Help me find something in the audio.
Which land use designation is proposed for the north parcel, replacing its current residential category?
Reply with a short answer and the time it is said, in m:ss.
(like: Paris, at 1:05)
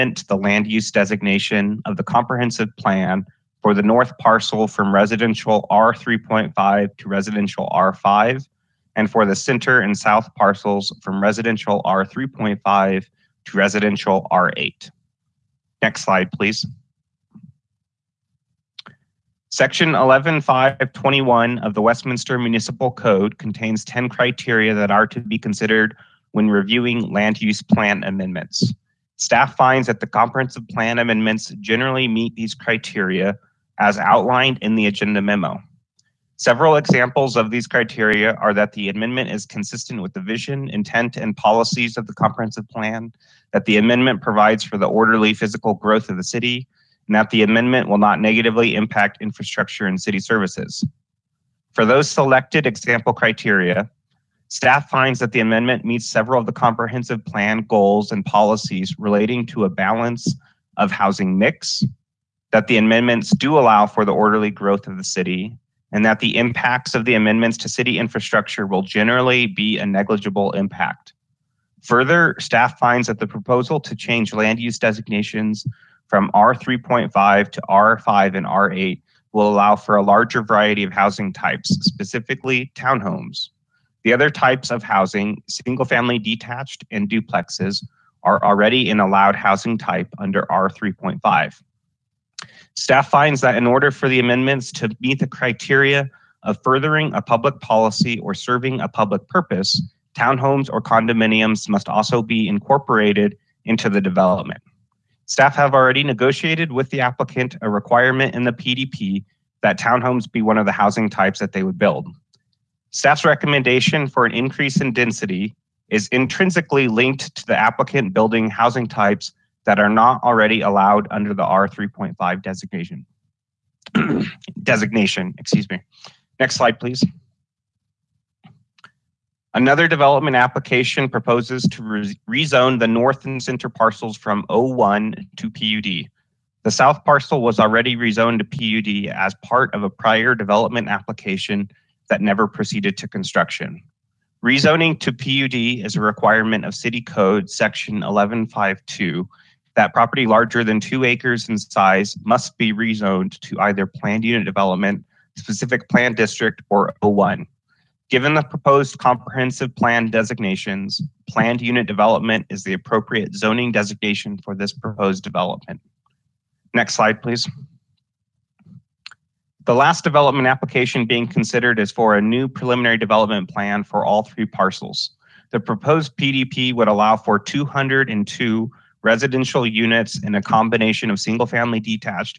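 R5, at 0:07.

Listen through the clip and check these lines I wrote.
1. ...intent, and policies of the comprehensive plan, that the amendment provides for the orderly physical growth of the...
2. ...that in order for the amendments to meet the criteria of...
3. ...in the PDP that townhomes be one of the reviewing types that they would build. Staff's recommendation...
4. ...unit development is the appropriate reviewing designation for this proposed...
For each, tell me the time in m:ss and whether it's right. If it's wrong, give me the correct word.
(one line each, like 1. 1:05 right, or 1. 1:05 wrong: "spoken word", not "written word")
1. 0:40 right
2. 1:33 right
3. 1:48 wrong: "housing", not "reviewing"
4. 2:41 wrong: "zoning", not "reviewing".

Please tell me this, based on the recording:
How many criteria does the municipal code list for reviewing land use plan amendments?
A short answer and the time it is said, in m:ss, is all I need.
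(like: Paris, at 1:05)
10, at 0:23.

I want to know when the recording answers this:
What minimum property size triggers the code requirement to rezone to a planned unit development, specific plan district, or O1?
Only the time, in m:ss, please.
2:30.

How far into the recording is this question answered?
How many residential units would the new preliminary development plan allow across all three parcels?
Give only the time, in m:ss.
2:57.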